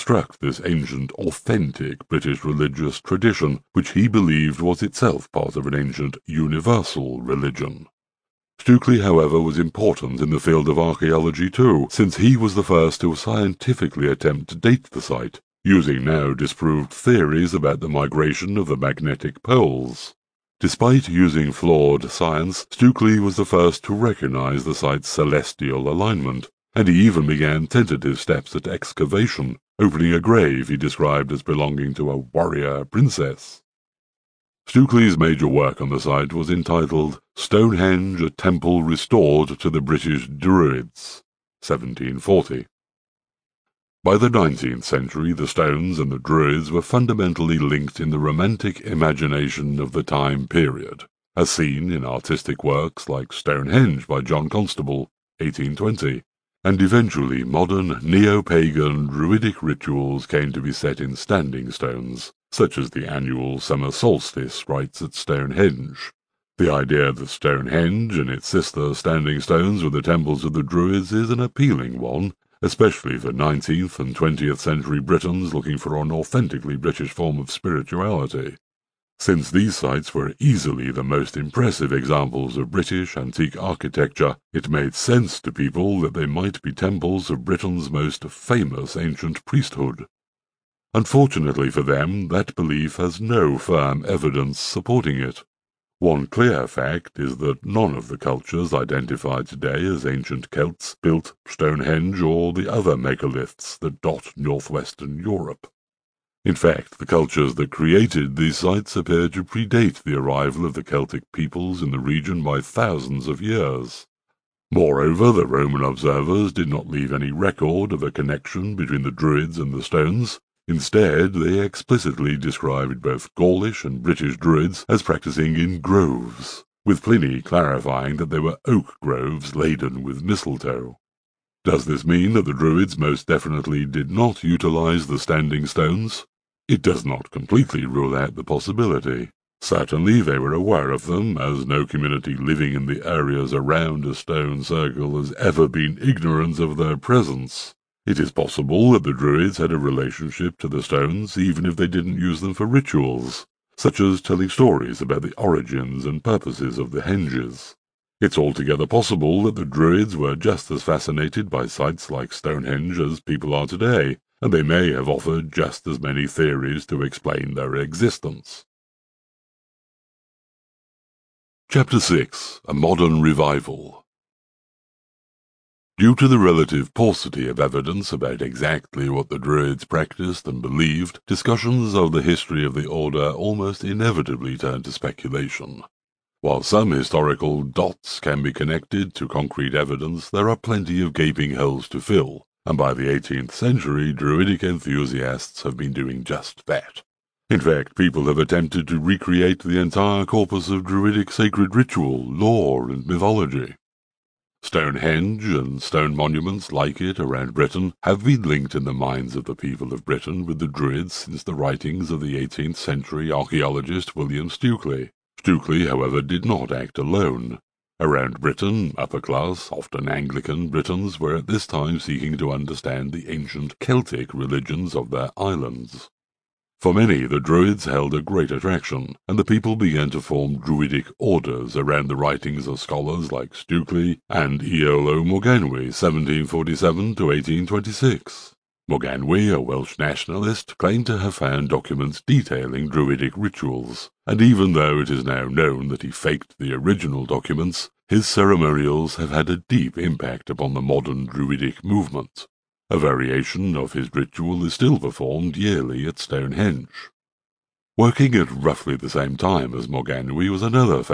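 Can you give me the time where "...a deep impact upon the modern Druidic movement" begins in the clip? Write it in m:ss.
4:09.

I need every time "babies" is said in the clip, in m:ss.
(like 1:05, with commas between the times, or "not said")
not said.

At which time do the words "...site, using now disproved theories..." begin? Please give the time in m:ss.
0:15.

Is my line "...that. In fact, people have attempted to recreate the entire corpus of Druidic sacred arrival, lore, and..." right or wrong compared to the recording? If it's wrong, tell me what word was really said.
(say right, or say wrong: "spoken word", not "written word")
wrong: "ritual", not "arrival".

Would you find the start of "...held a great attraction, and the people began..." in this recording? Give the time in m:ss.
3:47.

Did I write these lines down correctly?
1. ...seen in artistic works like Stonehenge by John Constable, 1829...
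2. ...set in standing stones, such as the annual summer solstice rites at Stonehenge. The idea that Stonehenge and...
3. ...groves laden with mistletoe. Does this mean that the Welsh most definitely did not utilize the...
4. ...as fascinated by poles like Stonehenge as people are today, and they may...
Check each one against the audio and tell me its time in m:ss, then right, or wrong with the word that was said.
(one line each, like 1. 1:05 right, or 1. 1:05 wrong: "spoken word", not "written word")
1. 0:51 wrong: "1820", not "1829"
2. 1:00 right
3. 2:09 wrong: "Druids", not "Welsh"
4. 2:40 wrong: "sites", not "poles".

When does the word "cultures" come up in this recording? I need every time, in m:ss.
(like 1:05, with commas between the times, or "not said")
1:38, 1:47.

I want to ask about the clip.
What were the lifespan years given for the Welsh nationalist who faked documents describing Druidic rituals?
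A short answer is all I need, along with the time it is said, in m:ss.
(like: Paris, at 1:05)
1747 to 1826, at 3:55.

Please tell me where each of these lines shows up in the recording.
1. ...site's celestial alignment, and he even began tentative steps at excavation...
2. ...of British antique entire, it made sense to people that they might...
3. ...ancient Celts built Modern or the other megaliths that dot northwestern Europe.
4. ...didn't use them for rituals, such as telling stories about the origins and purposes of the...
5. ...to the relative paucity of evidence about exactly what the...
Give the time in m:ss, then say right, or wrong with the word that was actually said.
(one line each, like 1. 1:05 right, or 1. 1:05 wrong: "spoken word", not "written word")
1. 0:24 right
2. 1:22 wrong: "architecture", not "entire"
3. 1:40 wrong: "Stonehenge", not "Modern"
4. 2:31 right
5. 2:56 right.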